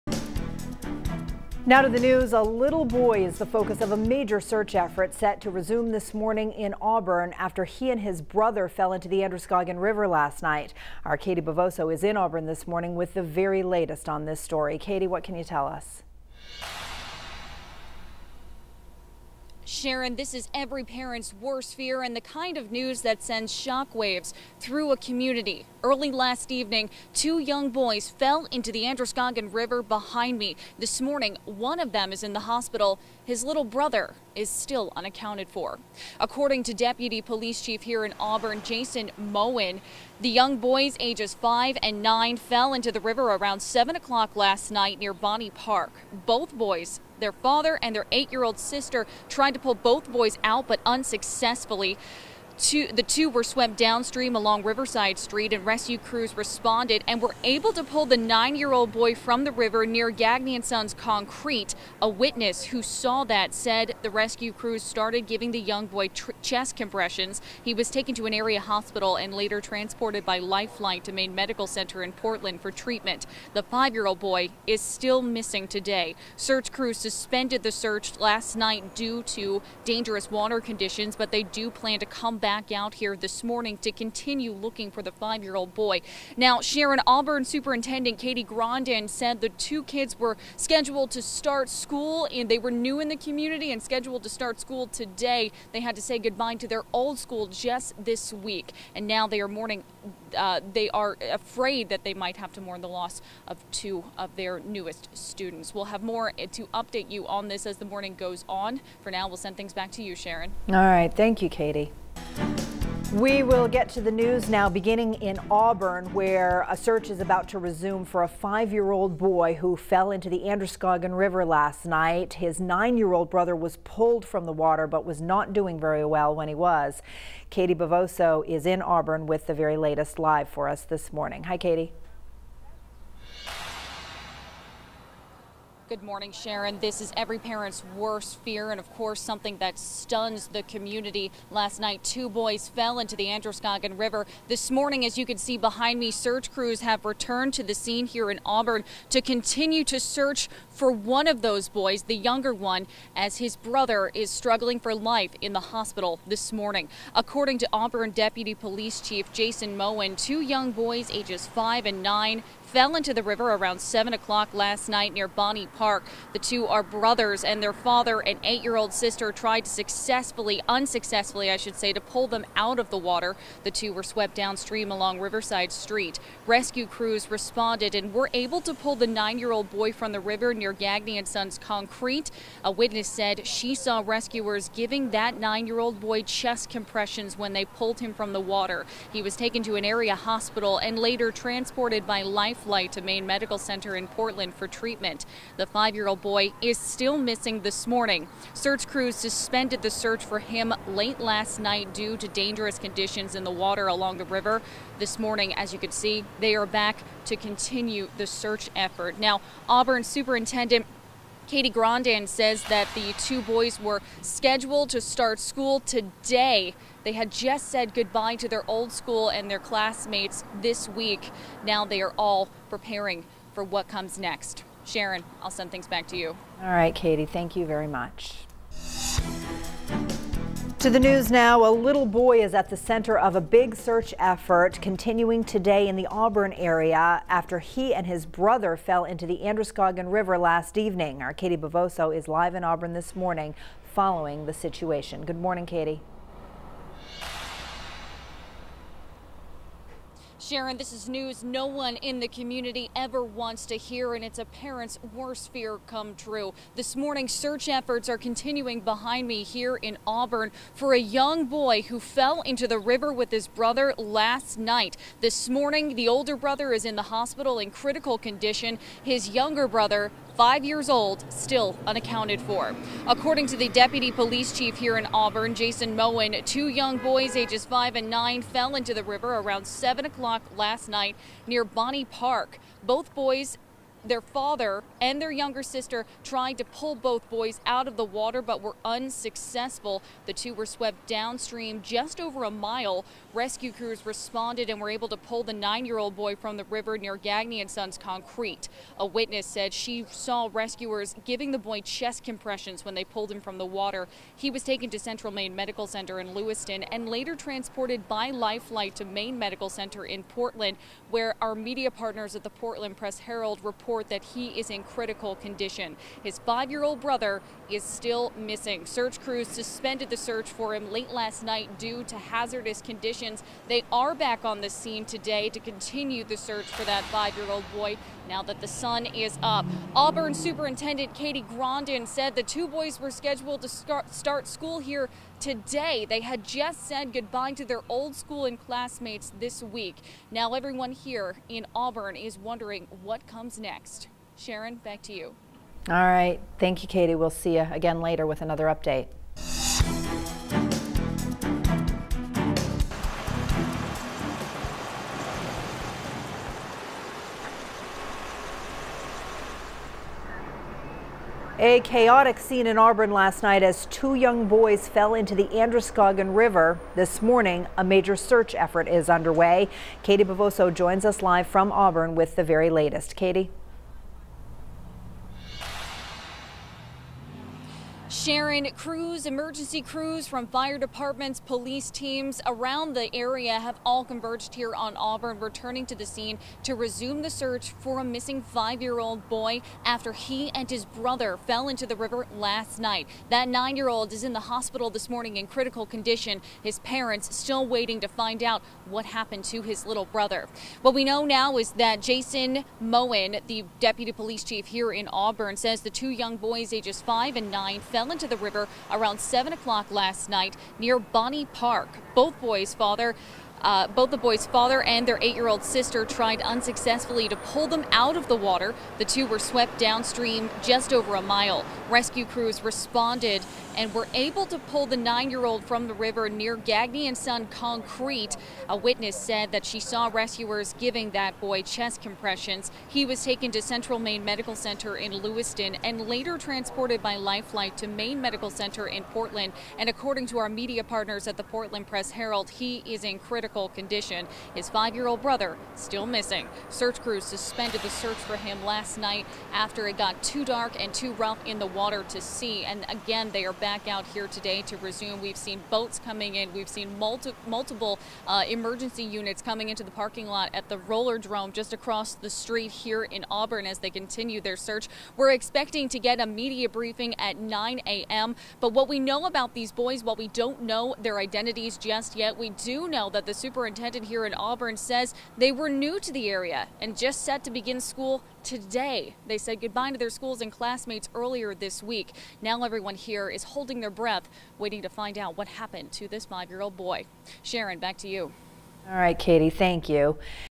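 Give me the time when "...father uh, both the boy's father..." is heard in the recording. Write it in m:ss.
6:52.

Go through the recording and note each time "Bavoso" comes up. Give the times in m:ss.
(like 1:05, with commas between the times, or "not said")
0:11, 2:07, 4:01, 6:10.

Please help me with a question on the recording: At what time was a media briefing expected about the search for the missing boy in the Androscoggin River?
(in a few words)
9 a.m.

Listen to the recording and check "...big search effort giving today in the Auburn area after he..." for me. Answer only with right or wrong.
wrong.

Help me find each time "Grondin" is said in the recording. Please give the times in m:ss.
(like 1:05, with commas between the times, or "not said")
1:28, 3:31, 5:31.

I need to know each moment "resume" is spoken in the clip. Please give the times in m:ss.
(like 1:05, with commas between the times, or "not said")
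0:05, 1:57, 6:26, 7:34.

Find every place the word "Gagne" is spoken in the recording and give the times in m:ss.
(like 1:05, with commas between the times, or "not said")
1:00, 3:00, 4:57, 7:06.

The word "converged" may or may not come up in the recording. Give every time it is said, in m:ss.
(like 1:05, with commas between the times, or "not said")
6:24.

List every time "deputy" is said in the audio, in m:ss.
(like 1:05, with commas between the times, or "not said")
0:36, 2:38, 4:33, 6:43.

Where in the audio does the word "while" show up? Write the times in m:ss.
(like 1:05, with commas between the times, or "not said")
7:50.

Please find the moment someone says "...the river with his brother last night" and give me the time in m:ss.
4:22.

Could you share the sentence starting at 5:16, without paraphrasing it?
His five-year-old brother is still missing.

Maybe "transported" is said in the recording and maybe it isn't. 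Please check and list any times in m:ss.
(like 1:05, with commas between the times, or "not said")
1:09, 3:11, 5:07, 7:16.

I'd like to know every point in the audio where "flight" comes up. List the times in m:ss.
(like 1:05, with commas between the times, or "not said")
3:12, 5:08, 7:17.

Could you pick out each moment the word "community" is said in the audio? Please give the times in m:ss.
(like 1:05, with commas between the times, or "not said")
0:24, 1:33, 2:20, 4:12.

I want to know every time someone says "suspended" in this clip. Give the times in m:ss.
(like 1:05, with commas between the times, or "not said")
1:16, 3:19, 5:19, 7:27.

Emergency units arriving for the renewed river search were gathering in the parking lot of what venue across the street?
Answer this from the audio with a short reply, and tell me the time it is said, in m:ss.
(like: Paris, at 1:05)
the roller drome, at 7:40.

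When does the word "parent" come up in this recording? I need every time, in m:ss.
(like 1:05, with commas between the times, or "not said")
0:20, 2:17, 4:14, 6:36.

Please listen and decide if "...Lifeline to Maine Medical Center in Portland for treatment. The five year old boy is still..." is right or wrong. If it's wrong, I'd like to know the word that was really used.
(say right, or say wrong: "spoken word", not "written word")
right.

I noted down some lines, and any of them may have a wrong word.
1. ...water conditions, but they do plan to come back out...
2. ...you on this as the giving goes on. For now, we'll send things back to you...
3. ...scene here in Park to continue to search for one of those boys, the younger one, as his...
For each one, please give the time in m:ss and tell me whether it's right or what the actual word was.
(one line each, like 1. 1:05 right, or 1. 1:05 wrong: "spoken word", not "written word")
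1. 1:20 right
2. 1:47 wrong: "morning", not "giving"
3. 2:27 wrong: "Auburn", not "Park".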